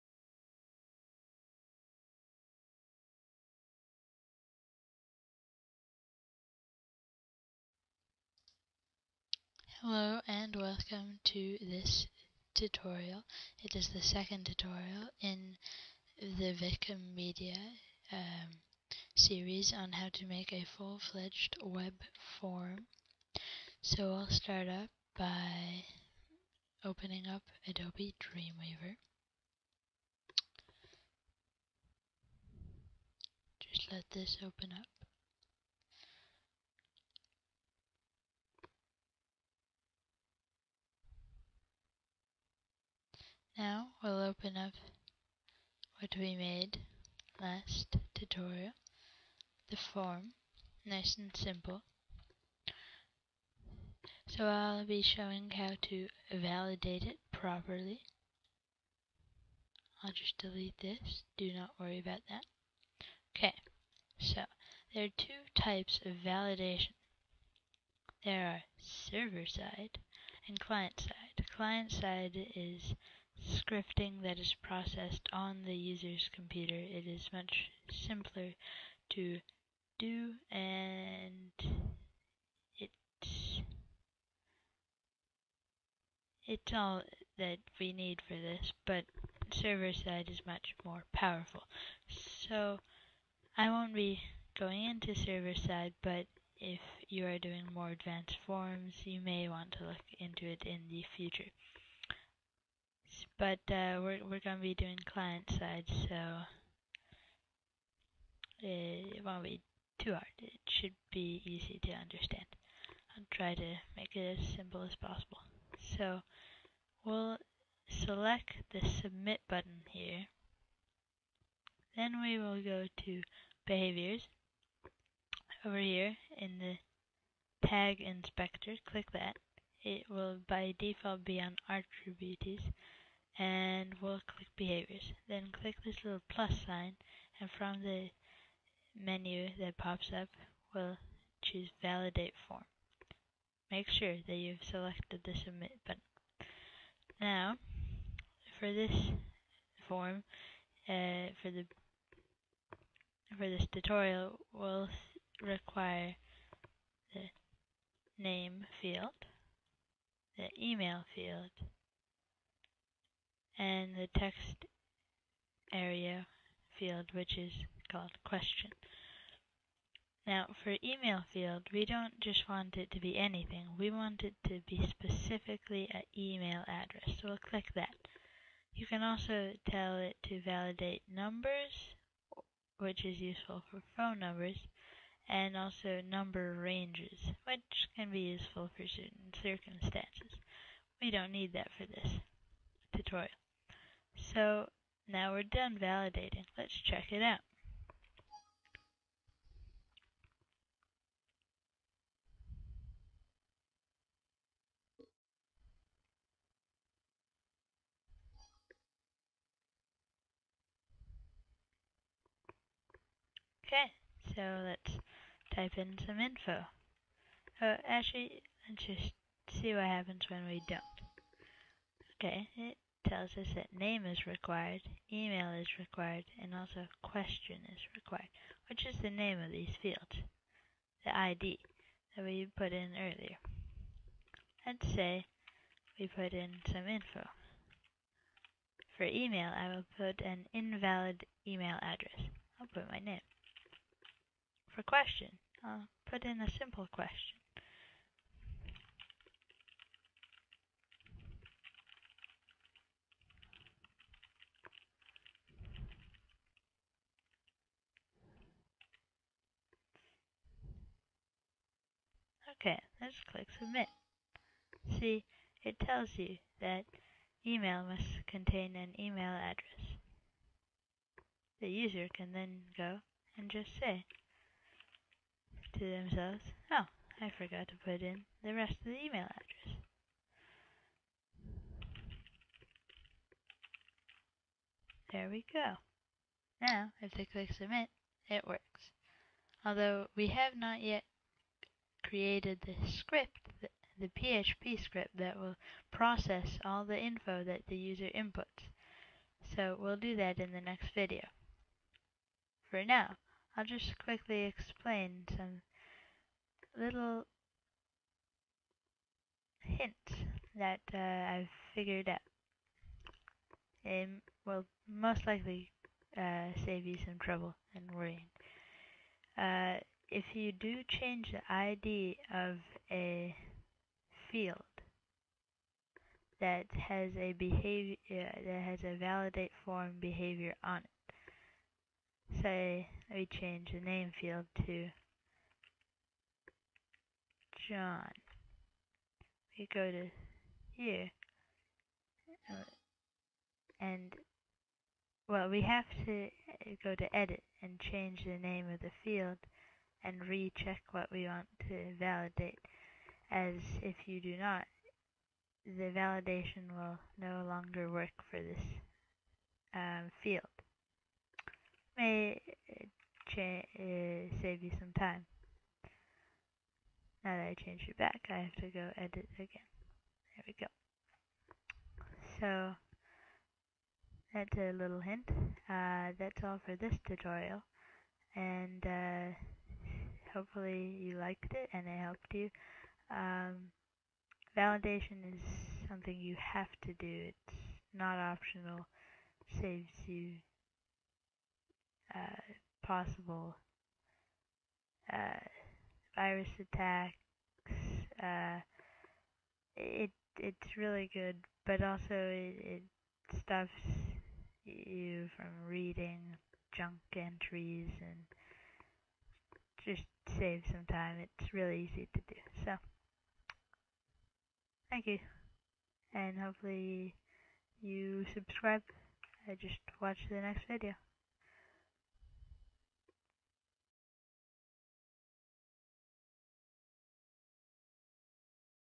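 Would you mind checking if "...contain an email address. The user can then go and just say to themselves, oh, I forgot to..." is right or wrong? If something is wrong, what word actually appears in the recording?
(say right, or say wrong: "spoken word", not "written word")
right.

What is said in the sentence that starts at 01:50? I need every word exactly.
It should be easy to understand.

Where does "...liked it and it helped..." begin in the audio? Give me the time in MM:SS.
06:21.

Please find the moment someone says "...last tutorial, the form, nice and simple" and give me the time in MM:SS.
00:47.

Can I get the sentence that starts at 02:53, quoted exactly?
We want it to be specifically an email address, so we'll click that.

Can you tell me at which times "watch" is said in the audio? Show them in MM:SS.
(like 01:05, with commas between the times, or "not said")
07:00.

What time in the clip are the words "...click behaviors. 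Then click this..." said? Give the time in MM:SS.
02:14.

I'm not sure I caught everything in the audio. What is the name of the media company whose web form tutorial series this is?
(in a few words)
Vikom Media.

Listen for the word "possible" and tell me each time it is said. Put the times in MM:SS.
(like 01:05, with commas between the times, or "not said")
01:55, 06:32.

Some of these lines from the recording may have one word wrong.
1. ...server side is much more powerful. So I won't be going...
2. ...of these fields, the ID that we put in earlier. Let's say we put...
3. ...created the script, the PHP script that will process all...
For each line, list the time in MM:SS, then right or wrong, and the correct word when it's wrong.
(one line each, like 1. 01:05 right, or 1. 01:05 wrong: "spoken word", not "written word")
1. 01:29 right
2. 03:49 right
3. 04:52 right.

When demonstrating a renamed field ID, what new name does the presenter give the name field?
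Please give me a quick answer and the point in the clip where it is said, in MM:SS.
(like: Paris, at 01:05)
John, at 05:37.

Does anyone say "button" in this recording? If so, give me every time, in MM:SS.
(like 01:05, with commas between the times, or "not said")
01:59, 02:25.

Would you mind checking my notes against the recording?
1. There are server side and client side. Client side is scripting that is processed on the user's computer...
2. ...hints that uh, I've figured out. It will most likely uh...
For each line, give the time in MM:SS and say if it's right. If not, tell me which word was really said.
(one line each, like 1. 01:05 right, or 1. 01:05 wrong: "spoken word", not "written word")
1. 01:08 right
2. 05:09 right.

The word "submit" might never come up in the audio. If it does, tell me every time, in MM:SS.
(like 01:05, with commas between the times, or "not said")
01:59, 02:25, 04:23, 04:47.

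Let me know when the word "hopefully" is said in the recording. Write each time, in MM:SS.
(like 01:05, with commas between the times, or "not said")
06:20, 06:56.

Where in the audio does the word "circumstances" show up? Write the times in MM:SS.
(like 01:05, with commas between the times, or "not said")
03:09.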